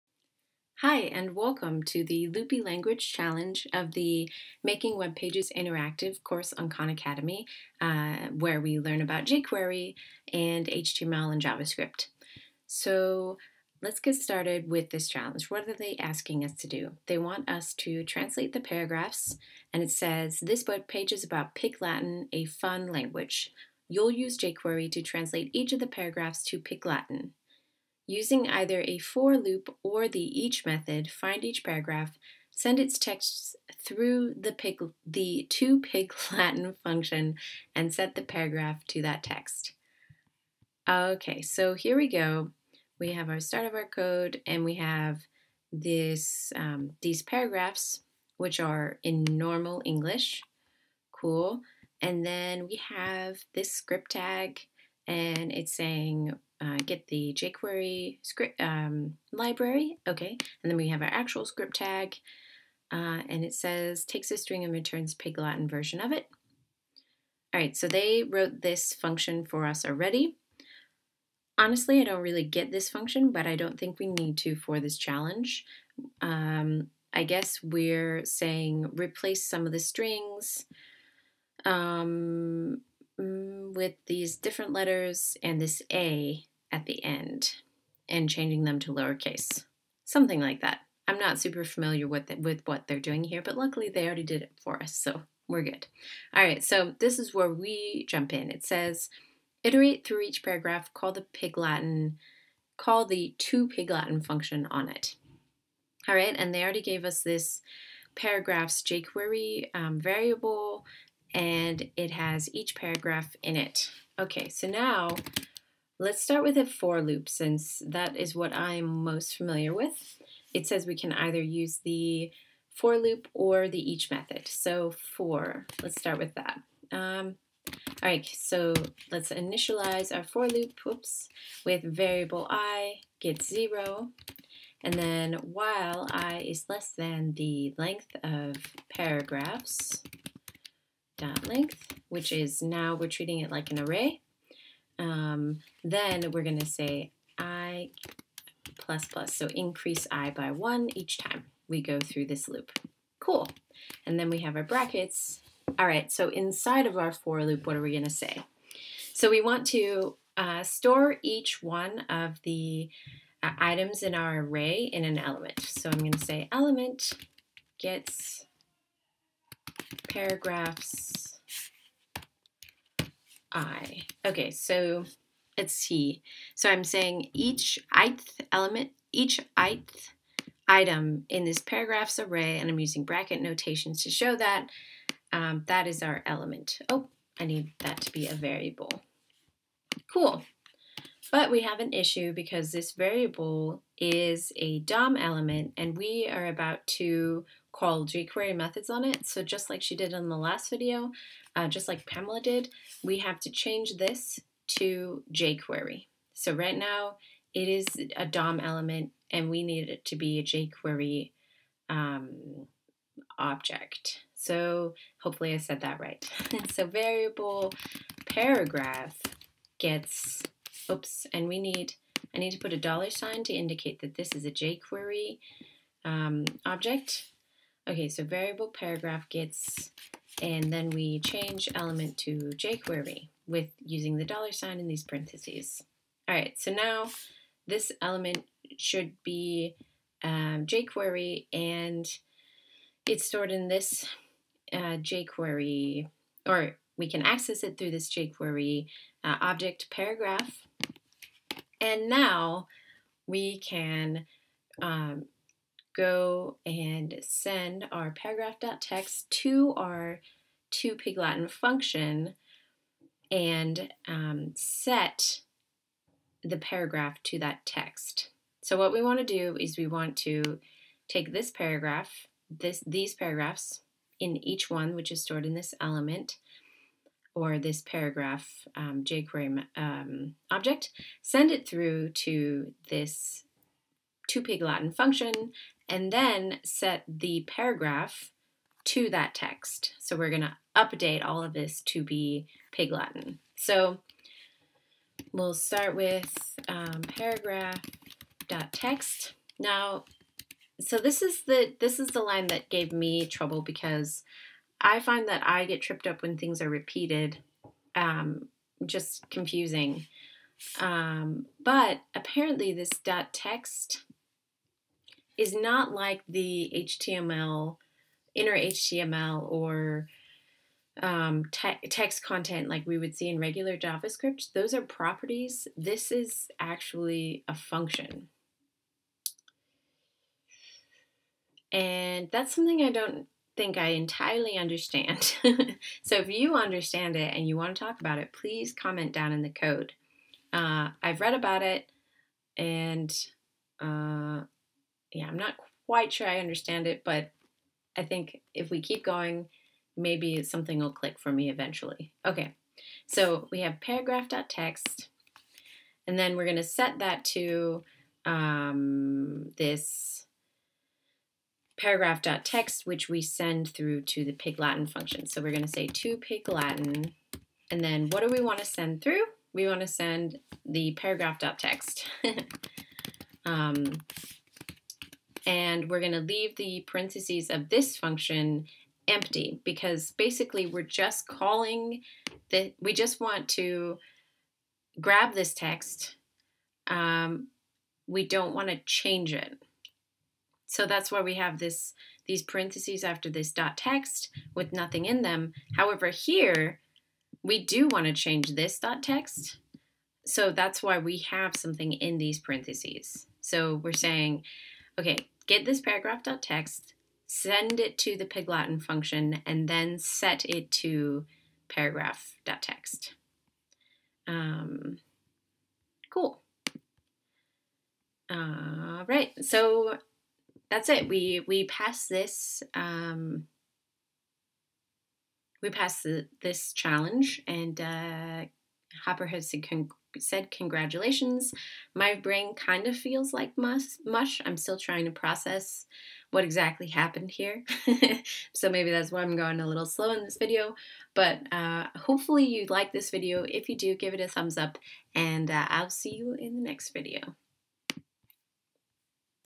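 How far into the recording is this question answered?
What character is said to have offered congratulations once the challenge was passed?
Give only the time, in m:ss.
7:09.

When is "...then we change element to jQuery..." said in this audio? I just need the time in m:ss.
3:50.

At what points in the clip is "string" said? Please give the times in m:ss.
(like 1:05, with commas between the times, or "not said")
1:04, 1:19.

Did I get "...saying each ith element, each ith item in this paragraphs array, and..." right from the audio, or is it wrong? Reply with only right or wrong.
right.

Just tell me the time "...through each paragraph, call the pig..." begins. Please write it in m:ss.
1:40.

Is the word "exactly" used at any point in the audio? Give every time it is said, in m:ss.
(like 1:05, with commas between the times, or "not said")
7:16.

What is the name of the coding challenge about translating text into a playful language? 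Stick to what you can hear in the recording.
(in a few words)
Loopy Language Challenge.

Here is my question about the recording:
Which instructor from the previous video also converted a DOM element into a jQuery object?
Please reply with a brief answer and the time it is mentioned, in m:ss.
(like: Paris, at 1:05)
Pamela, at 3:22.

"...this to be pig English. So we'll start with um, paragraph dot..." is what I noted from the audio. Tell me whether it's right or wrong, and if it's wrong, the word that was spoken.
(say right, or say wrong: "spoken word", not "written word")
wrong: "Latin", not "English".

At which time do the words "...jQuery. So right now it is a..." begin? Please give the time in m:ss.
3:25.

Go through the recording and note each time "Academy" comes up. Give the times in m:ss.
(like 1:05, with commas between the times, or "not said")
0:06.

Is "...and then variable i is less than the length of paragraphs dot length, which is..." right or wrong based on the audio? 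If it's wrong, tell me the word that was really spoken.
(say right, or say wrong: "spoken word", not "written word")
wrong: "while", not "variable".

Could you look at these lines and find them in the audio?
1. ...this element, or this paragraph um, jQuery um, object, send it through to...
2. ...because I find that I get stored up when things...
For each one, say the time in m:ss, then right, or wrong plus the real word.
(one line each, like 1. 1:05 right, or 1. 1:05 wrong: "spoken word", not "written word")
1. 4:35 right
2. 5:03 wrong: "tripped", not "stored".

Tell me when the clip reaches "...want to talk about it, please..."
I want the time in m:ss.
5:37.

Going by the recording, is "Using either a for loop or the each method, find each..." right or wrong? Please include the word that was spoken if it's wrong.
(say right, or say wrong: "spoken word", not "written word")
right.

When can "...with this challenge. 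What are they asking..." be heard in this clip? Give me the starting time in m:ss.
0:14.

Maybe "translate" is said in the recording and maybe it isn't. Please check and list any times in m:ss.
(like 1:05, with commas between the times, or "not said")
0:18, 0:25.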